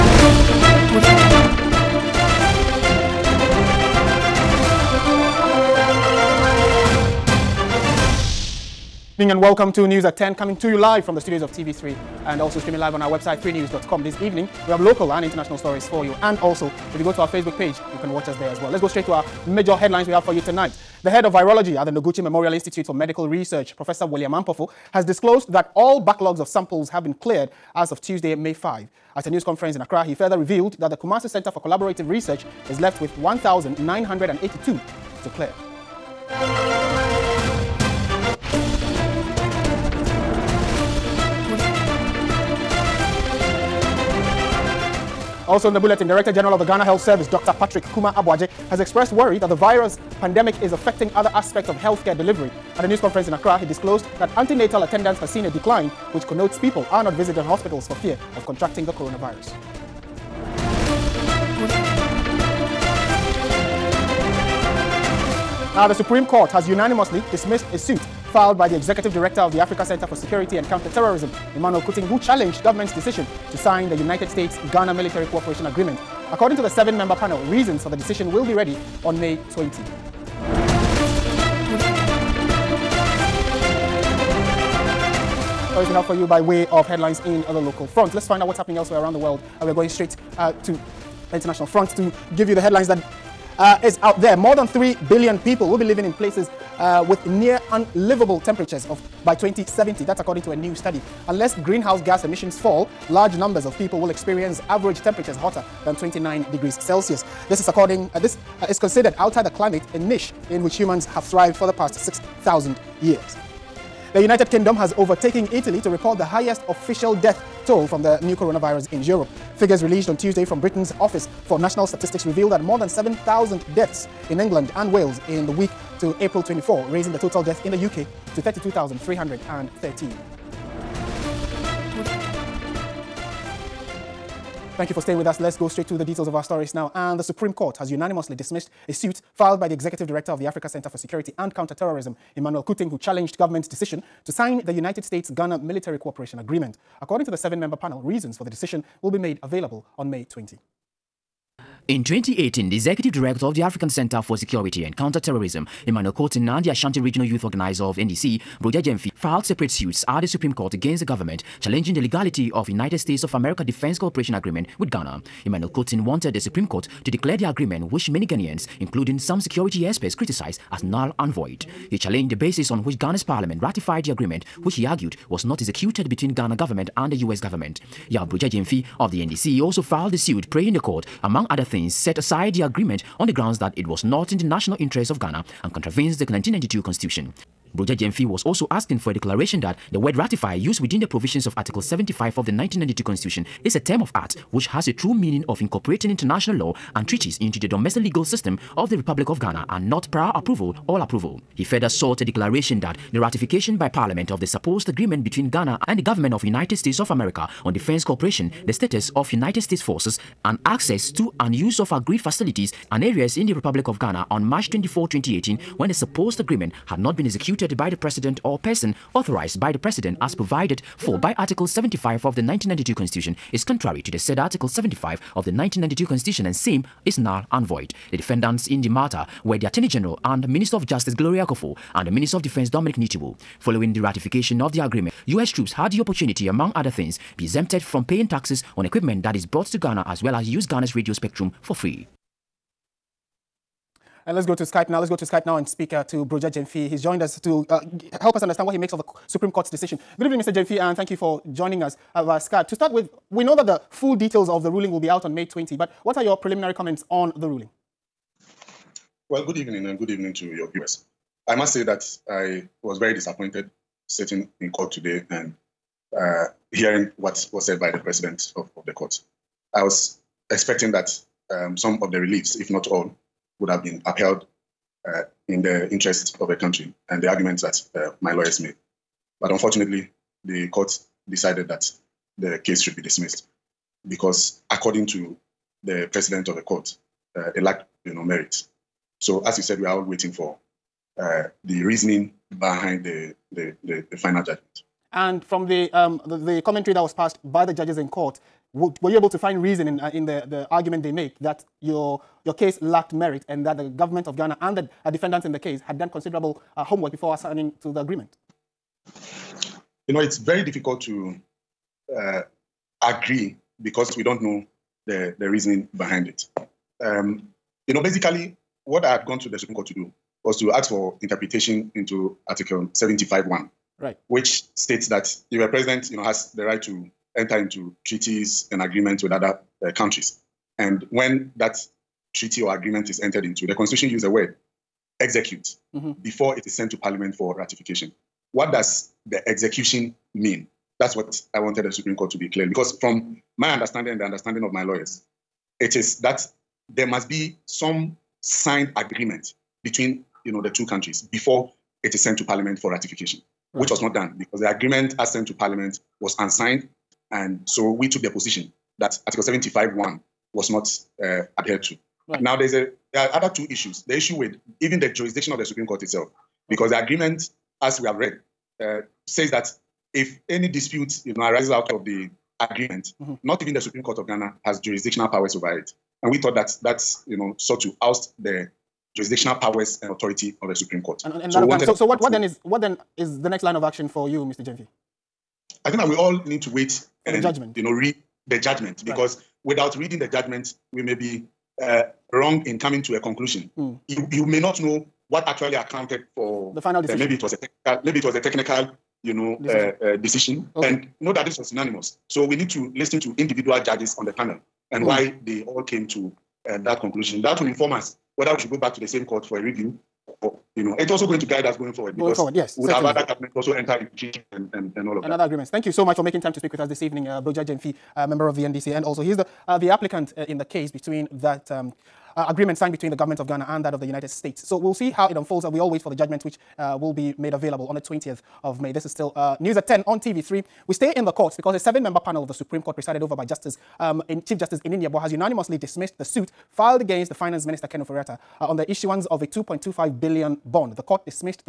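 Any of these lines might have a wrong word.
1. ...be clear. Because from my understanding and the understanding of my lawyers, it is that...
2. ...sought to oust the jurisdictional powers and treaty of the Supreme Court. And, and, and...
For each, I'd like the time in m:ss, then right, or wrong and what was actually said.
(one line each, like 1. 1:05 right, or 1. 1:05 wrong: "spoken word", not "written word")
1. 5:42 right
2. 6:17 wrong: "authority", not "treaty".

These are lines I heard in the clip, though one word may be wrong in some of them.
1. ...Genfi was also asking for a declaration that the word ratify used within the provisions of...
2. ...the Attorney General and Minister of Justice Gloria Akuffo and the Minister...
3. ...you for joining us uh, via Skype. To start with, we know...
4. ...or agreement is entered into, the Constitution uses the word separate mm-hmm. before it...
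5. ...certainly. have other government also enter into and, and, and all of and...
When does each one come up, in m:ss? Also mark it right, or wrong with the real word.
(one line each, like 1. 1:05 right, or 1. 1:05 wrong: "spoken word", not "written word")
1. 3:07 right
2. 3:49 right
3. 4:11 right
4. 5:32 wrong: "execute", not "separate"
5. 6:52 right.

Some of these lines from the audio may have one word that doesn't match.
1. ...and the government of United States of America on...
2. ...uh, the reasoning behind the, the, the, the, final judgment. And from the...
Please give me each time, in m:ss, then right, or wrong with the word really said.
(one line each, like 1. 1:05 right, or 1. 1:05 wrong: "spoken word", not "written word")
1. 3:25 right
2. 4:51 right.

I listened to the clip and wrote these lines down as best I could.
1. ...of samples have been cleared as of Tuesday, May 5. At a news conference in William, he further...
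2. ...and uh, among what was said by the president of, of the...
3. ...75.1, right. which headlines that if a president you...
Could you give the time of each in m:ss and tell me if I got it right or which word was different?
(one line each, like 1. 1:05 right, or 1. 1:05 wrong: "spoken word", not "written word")
1. 0:26 wrong: "Accra", not "William"
2. 4:25 wrong: "hearing", not "among"
3. 5:22 wrong: "states", not "headlines".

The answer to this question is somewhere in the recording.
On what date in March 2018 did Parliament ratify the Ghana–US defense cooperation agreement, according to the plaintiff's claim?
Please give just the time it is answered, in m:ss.
3:34.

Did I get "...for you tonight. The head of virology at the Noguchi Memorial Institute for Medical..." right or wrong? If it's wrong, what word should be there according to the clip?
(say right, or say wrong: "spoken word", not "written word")
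right.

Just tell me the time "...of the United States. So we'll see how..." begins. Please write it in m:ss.
7:03.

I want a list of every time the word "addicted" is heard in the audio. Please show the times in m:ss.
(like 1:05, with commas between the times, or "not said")
not said.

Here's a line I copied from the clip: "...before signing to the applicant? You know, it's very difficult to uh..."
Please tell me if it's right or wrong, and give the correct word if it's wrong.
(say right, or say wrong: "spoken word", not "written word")
wrong: "agreement", not "applicant".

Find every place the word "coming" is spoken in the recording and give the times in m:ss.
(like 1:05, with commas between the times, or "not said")
0:10, 6:32.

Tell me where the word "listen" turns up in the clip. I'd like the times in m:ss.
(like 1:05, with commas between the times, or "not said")
6:42.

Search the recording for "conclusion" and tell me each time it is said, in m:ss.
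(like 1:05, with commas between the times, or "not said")
6:33, 6:46.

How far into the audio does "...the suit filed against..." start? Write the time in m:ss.
7:16.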